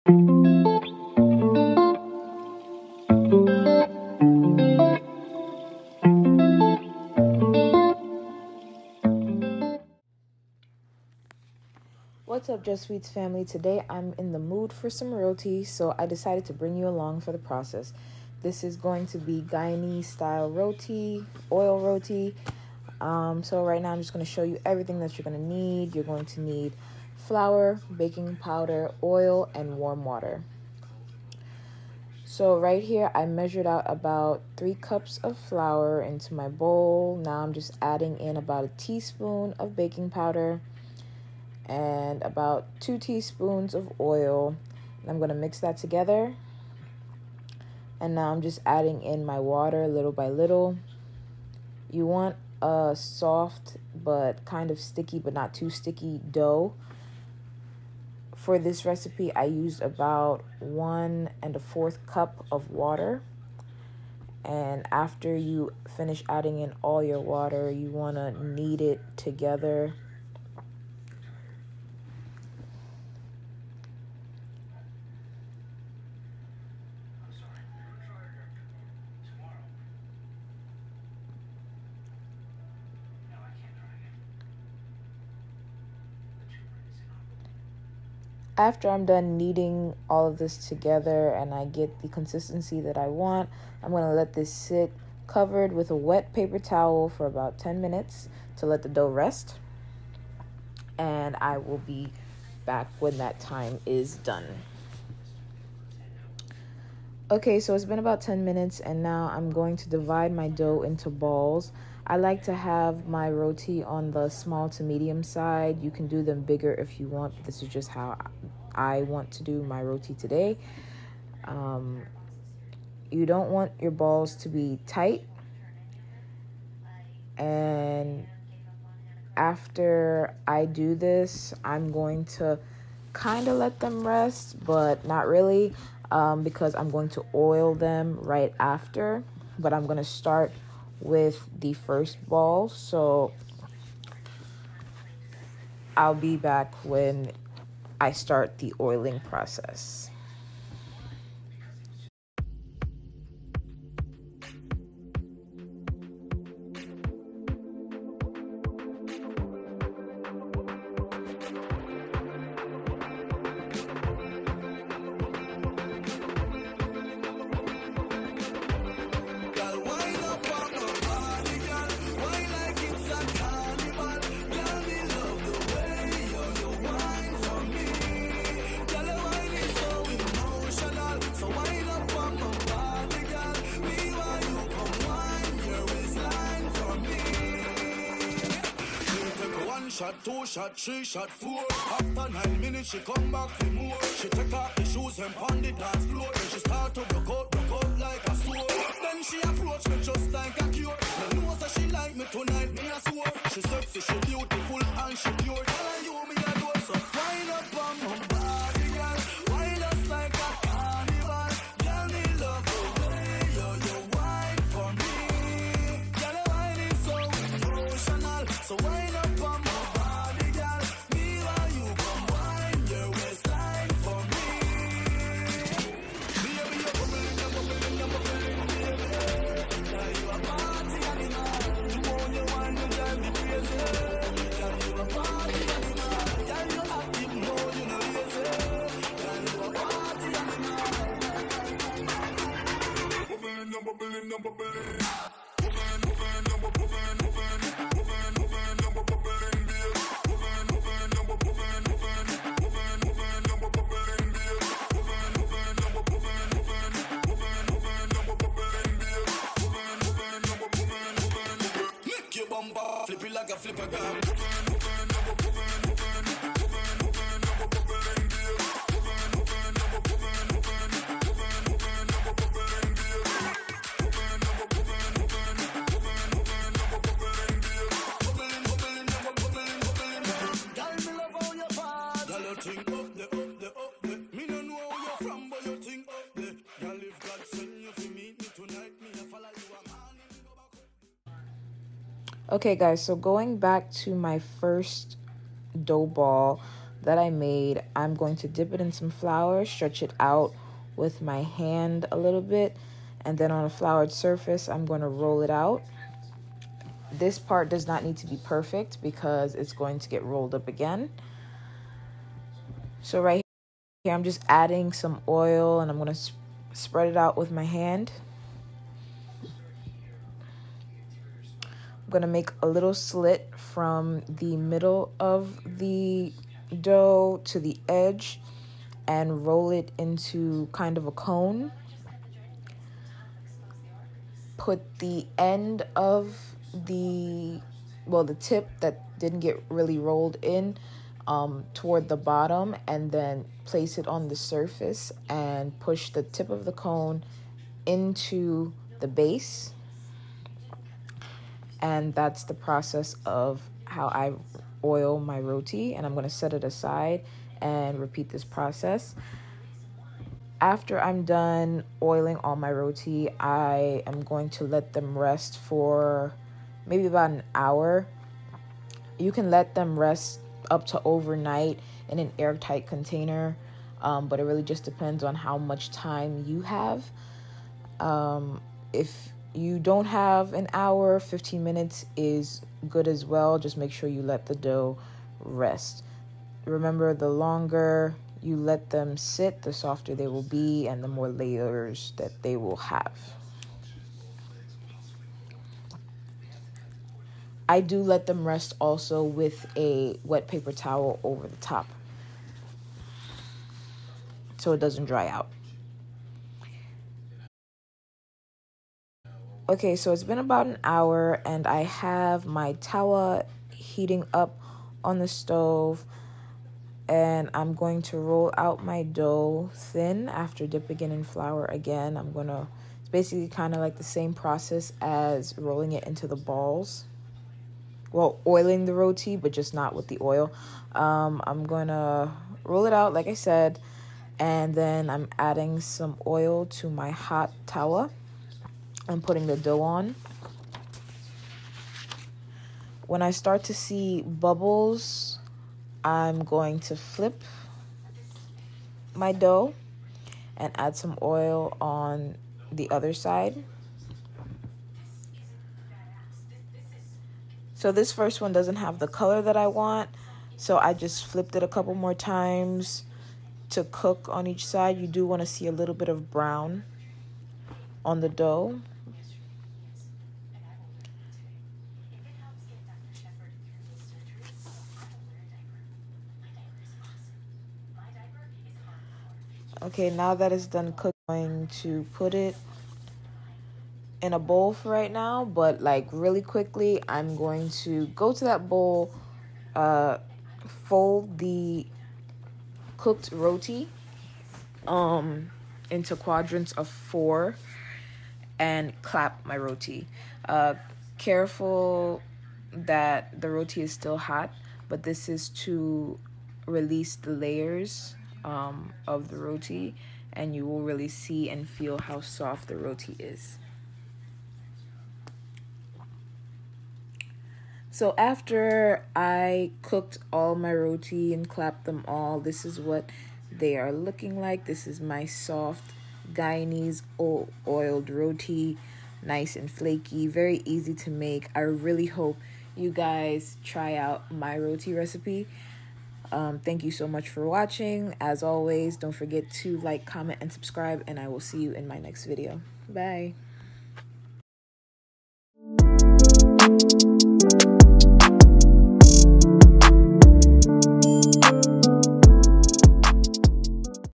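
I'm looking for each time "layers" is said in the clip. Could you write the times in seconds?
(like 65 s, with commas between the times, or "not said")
391 s, 507 s.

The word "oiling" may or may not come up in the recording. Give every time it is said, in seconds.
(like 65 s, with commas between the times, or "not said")
148 s, 362 s, 428 s.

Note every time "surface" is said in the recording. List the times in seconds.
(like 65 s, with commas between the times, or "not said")
304 s, 344 s.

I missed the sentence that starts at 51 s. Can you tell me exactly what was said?
You want a soft but kind of sticky but not too sticky dough.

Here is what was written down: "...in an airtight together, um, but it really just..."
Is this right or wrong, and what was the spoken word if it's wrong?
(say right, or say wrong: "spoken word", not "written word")
wrong: "container", not "together".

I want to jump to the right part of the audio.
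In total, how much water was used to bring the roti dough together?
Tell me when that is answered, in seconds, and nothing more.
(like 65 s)
60 s.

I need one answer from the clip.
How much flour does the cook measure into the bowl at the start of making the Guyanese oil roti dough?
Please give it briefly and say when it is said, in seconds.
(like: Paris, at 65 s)
3 cups, at 34 s.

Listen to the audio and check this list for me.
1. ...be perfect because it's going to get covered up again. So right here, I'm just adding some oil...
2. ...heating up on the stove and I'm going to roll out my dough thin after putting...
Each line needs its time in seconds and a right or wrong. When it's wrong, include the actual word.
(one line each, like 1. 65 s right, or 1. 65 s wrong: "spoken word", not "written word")
1. 308 s wrong: "rolled", not "covered"
2. 413 s wrong: "dipping", not "putting".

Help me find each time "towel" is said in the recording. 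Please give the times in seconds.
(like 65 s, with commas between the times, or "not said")
96 s, 400 s.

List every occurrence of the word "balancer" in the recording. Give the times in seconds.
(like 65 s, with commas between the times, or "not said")
not said.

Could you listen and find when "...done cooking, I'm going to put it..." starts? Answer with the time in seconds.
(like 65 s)
480 s.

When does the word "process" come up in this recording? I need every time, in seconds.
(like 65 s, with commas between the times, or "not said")
17 s, 149 s, 352 s, 358 s, 424 s.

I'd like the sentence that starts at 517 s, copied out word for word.
So after I cooked all my roti and clapped them all, this is what they are looking like.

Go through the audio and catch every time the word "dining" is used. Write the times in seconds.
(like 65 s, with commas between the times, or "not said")
not said.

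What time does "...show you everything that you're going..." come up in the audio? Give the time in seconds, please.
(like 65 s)
24 s.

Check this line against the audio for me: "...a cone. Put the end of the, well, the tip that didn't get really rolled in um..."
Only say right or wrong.
right.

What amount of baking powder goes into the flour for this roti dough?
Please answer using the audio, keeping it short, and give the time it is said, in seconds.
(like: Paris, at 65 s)
1 teaspoon, at 38 s.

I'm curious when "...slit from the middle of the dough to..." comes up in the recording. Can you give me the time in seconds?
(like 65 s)
322 s.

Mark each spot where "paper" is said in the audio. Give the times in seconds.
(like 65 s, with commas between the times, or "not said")
96 s, 400 s.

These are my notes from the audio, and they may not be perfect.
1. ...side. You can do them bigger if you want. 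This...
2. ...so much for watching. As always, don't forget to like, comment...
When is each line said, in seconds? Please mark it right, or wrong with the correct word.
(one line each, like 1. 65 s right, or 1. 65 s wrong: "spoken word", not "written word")
1. 115 s right
2. 536 s right.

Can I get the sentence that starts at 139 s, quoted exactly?
But I'm going to start with the first ball.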